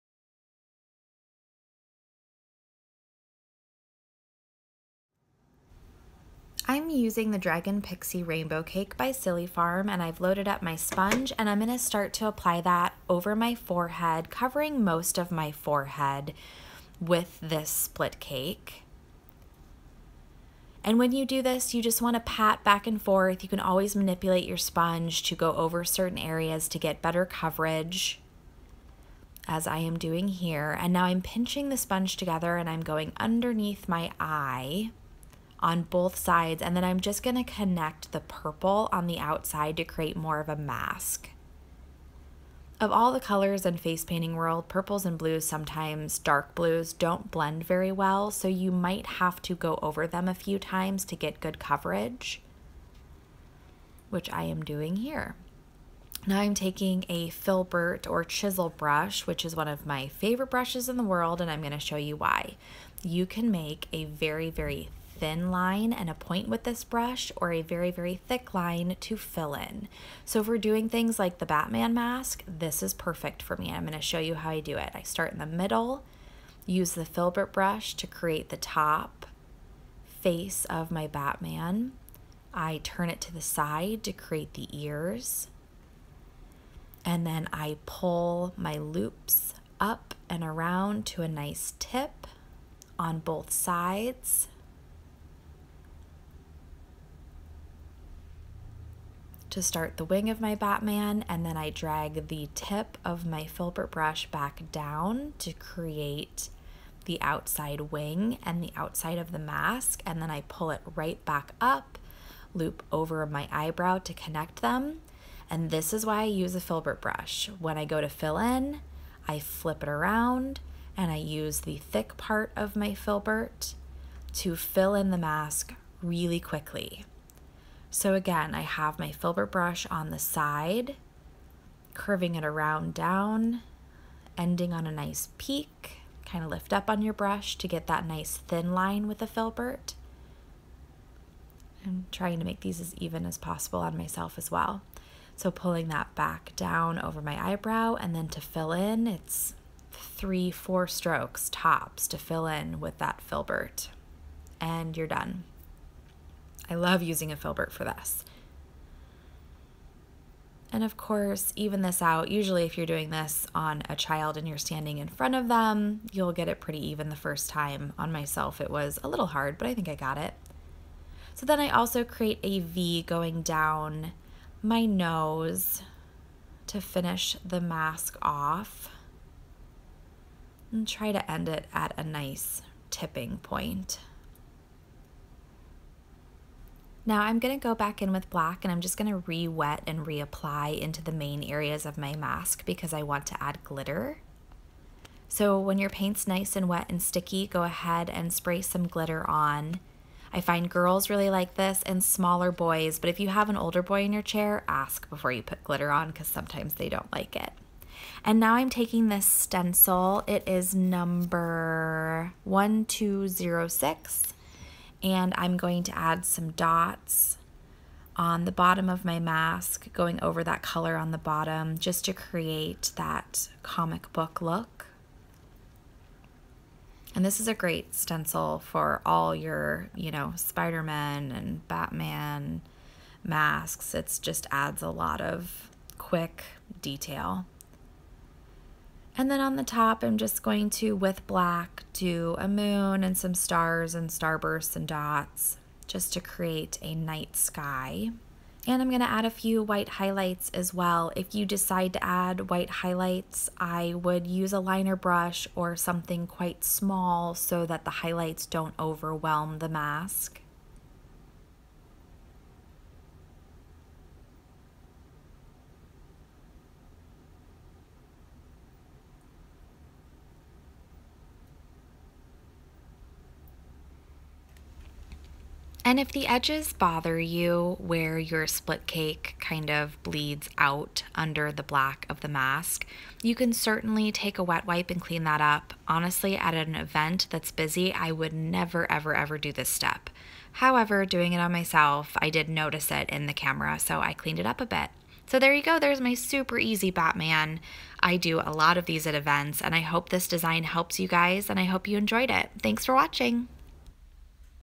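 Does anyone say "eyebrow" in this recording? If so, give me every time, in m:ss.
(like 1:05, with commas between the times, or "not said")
1:53, 2:27.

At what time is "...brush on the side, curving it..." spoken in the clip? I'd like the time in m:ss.
2:09.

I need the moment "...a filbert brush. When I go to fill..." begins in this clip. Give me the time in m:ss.
1:56.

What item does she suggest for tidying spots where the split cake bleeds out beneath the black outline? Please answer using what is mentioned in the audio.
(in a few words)
A wet wipe.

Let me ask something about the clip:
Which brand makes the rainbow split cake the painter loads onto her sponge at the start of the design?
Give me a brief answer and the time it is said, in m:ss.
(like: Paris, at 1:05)
Silly Farm, at 0:09.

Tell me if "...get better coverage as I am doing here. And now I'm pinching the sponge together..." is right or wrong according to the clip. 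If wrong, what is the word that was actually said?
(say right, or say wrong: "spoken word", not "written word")
right.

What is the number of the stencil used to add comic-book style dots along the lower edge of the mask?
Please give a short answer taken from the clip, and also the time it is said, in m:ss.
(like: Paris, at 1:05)
1206, at 3:32.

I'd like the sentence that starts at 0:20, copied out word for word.
And when you do this, you just want to pat back and forth.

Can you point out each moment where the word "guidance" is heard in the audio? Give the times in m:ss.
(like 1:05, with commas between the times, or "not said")
not said.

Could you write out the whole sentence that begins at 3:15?
So when your paint's nice and wet and sticky, go ahead and spray some glitter on.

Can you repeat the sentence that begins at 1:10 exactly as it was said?
So if we're doing things like the Batman mask, this is perfect for me.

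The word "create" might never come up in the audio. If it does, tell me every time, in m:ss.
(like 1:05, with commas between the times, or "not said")
0:39, 1:18, 1:24, 1:45, 2:52, 3:42, 4:06.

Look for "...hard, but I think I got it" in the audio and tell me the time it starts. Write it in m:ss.
2:49.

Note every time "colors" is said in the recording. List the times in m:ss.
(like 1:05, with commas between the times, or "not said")
0:43, 3:40.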